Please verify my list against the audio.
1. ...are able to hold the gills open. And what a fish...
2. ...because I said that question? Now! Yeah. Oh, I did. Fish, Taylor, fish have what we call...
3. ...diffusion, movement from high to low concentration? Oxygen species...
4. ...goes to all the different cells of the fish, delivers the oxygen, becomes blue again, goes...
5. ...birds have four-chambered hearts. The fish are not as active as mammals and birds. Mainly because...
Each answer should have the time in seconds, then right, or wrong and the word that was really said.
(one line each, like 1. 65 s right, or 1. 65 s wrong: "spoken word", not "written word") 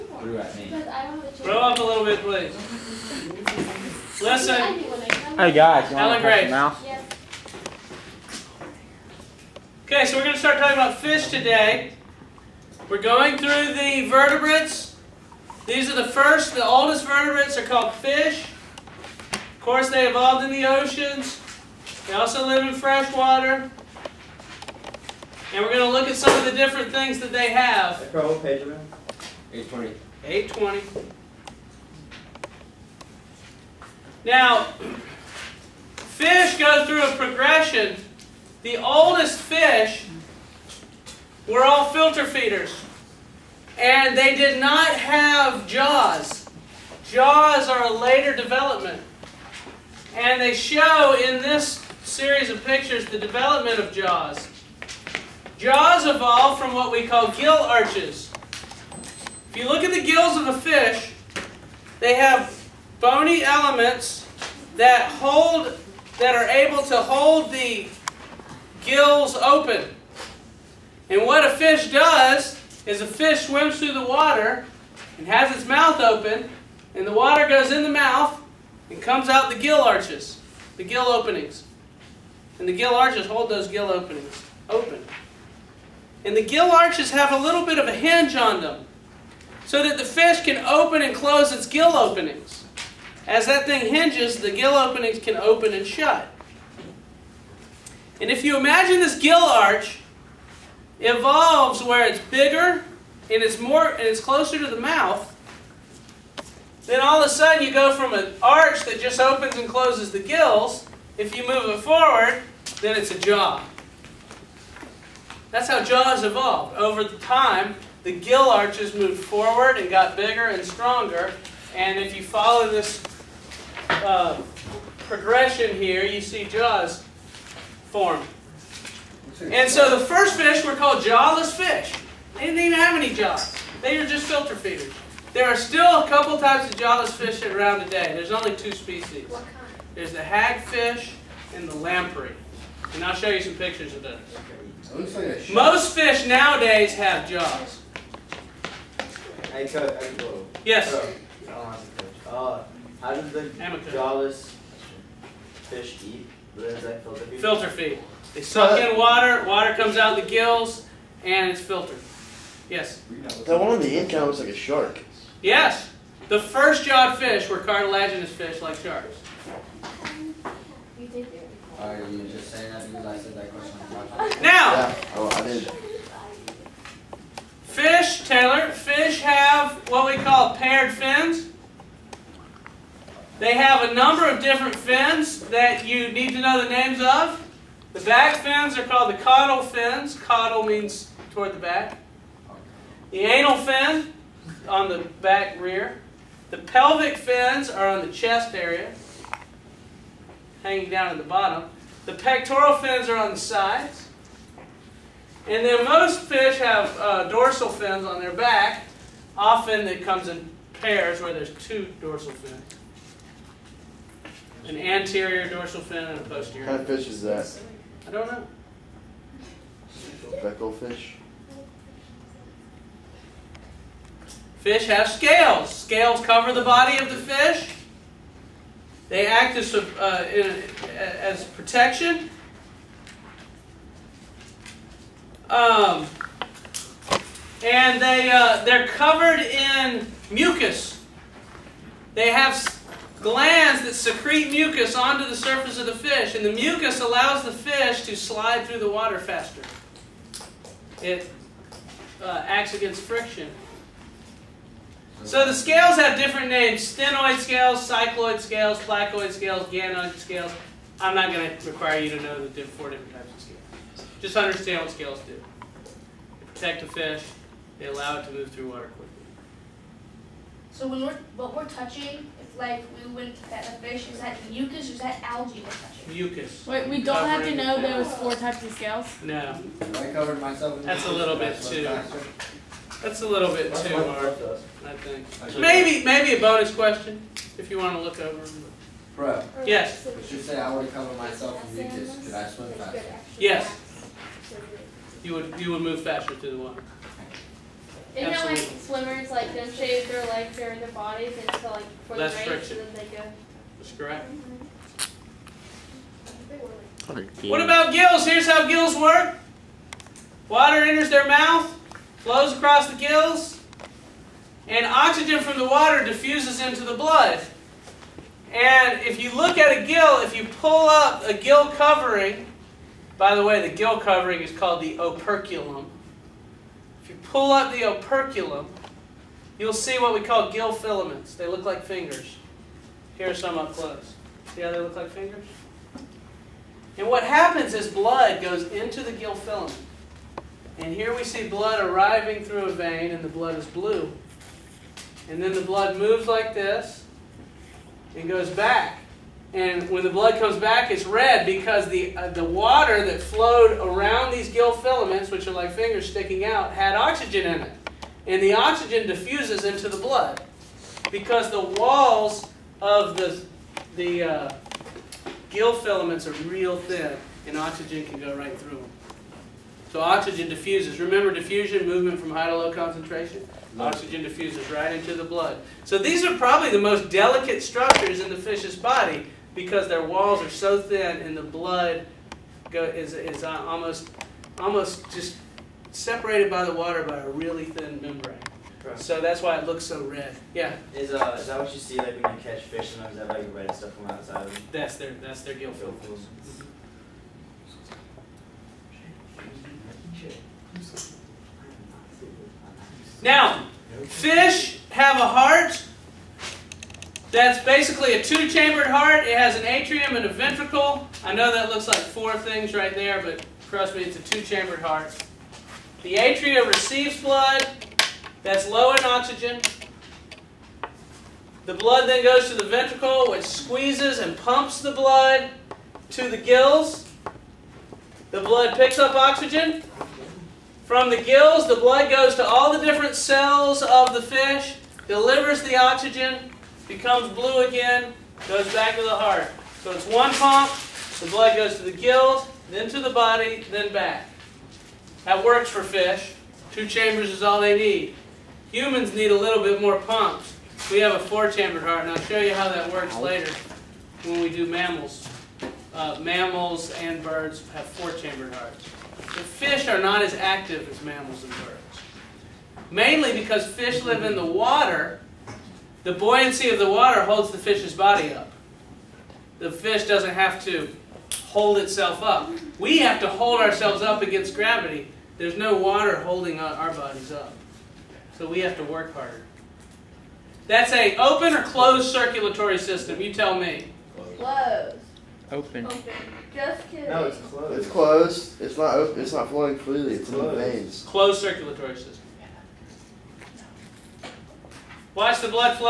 1. 66 s right
2. 172 s right
3. 371 s wrong: "diffuses", not "species"
4. 432 s right
5. 457 s right.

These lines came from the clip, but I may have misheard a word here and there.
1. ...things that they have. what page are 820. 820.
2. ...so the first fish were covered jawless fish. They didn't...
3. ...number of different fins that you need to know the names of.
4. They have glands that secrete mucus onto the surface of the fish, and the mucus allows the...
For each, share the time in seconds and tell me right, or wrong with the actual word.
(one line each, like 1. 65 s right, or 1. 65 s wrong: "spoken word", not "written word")
1. 26 s right
2. 129 s wrong: "called", not "covered"
3. 183 s right
4. 242 s right.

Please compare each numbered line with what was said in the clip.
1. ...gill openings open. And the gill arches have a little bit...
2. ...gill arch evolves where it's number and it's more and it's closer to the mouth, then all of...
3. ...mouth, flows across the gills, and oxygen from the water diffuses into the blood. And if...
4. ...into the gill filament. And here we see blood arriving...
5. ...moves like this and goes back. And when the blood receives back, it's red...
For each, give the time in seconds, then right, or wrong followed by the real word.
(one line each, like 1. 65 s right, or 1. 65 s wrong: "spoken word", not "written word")
1. 83 s right
2. 99 s wrong: "bigger", not "number"
3. 311 s right
4. 338 s right
5. 345 s wrong: "comes", not "receives".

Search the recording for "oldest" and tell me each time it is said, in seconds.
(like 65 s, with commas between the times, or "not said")
16 s, 38 s.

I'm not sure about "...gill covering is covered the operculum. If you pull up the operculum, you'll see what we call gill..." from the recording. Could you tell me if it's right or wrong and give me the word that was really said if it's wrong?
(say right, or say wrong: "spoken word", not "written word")
wrong: "called", not "covered".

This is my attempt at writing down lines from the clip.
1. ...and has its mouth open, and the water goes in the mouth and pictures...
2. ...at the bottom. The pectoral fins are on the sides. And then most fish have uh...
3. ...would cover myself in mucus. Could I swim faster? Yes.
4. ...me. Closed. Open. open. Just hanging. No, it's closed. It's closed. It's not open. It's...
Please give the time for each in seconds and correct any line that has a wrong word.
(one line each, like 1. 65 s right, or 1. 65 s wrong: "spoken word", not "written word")
1. 75 s wrong: "comes", not "pictures"
2. 201 s right
3. 290 s right
4. 483 s wrong: "kidding", not "hanging".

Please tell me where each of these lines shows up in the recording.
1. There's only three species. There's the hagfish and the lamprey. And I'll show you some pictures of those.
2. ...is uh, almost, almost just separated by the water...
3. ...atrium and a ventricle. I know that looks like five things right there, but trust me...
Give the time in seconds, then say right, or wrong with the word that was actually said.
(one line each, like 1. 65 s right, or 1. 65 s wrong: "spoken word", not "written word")
1. 138 s wrong: "two", not "three"
2. 383 s right
3. 409 s wrong: "four", not "five".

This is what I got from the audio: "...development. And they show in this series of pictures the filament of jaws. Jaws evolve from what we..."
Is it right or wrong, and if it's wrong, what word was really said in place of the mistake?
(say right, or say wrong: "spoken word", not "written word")
wrong: "development", not "filament".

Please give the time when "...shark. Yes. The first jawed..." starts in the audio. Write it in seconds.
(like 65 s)
164 s.